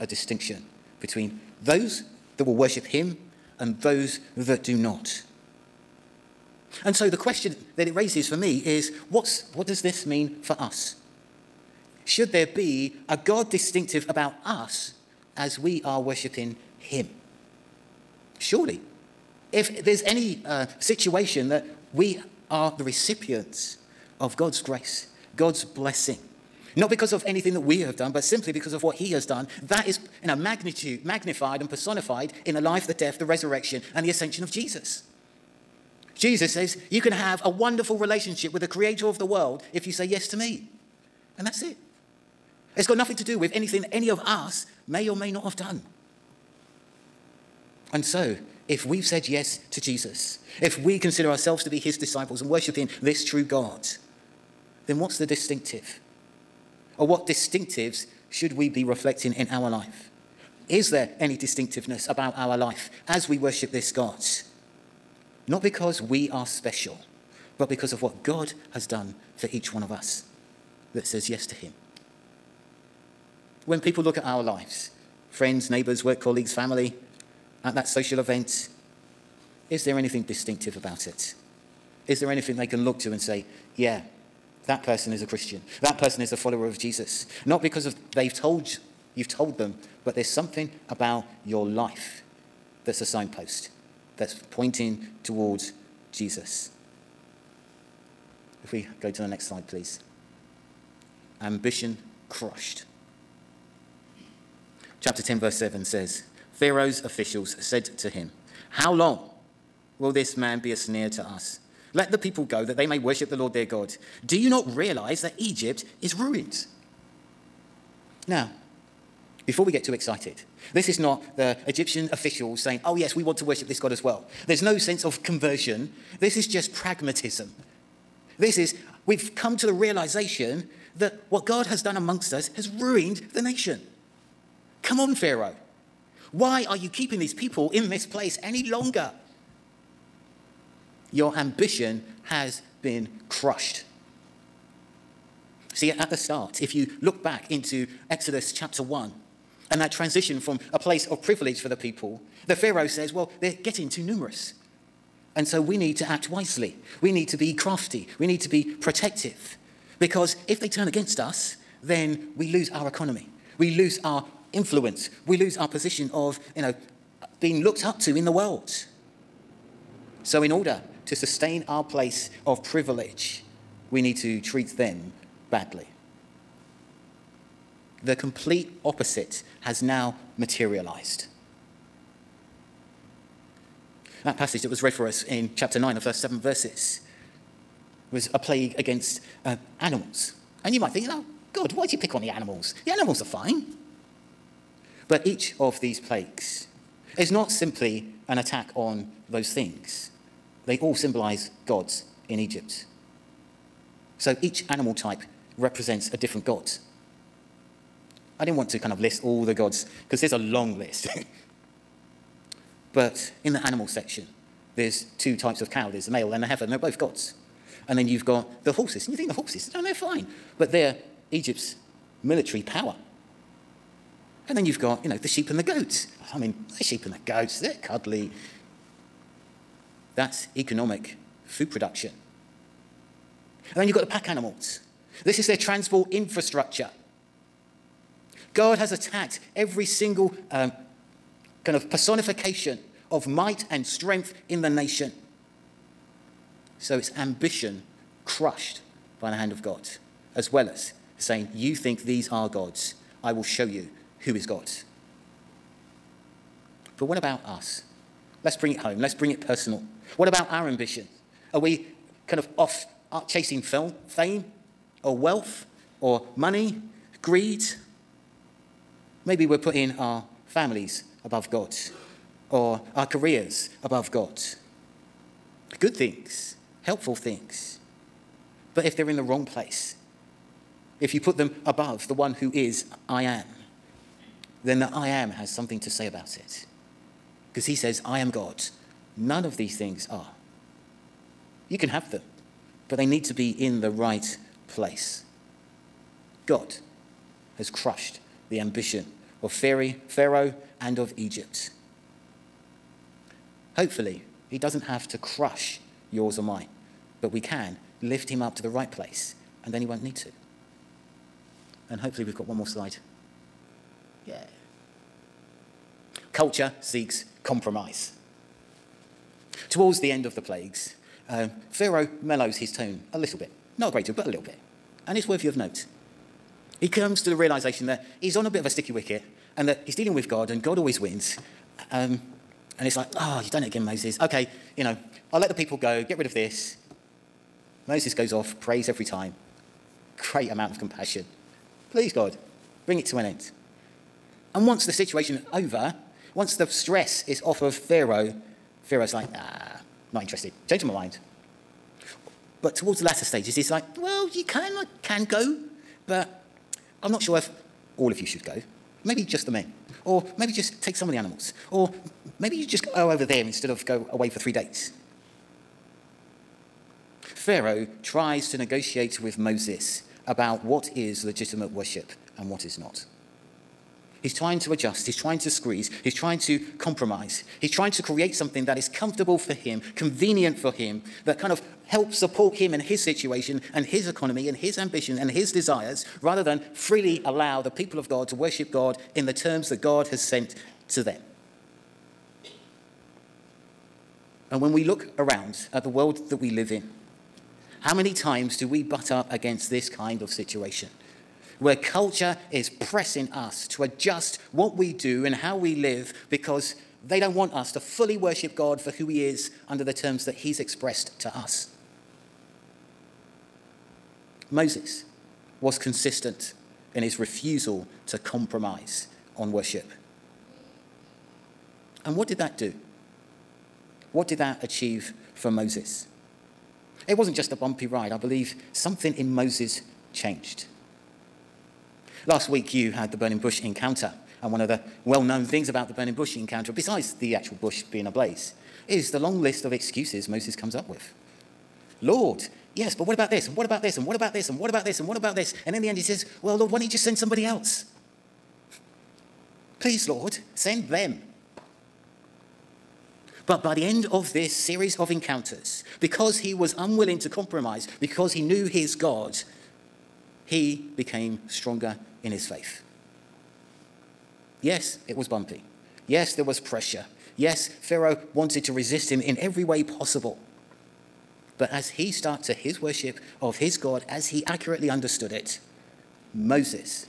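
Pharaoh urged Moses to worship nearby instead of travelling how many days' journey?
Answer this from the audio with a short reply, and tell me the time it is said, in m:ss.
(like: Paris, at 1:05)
3, at 6:04.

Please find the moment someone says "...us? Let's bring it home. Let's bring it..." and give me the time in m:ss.
4:17.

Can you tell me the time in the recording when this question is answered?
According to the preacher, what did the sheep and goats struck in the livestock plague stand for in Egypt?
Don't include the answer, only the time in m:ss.
3:50.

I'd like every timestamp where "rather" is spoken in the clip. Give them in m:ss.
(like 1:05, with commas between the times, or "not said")
6:26.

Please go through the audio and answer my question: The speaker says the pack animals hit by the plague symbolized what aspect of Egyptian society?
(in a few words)
Transport infrastructure.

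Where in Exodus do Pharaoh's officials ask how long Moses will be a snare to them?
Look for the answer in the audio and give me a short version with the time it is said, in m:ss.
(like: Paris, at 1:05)
Chapter 10, verse 7, at 1:45.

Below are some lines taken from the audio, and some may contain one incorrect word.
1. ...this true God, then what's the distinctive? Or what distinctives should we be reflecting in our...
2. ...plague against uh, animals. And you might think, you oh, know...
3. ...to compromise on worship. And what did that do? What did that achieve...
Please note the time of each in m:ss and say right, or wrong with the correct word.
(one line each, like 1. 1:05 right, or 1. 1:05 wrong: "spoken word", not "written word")
1. 0:53 right
2. 3:08 right
3. 6:58 right.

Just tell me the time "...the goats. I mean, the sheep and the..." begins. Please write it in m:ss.
3:45.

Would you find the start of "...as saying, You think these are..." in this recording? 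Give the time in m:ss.
4:10.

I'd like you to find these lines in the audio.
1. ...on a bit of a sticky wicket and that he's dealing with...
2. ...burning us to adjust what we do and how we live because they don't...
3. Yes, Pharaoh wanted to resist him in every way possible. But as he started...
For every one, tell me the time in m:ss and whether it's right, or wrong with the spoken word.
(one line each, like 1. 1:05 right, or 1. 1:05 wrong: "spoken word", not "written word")
1. 5:28 right
2. 6:42 wrong: "pressing", not "burning"
3. 7:47 right.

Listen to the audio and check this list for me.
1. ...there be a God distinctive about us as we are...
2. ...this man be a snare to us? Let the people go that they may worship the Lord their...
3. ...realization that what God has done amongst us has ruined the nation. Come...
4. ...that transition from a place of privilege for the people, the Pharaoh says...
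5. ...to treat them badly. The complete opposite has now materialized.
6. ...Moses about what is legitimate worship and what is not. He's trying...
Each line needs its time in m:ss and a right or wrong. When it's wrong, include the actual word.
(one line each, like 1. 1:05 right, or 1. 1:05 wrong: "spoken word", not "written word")
1. 0:12 right
2. 1:50 right
3. 2:09 right
4. 2:29 right
5. 2:54 right
6. 6:09 right.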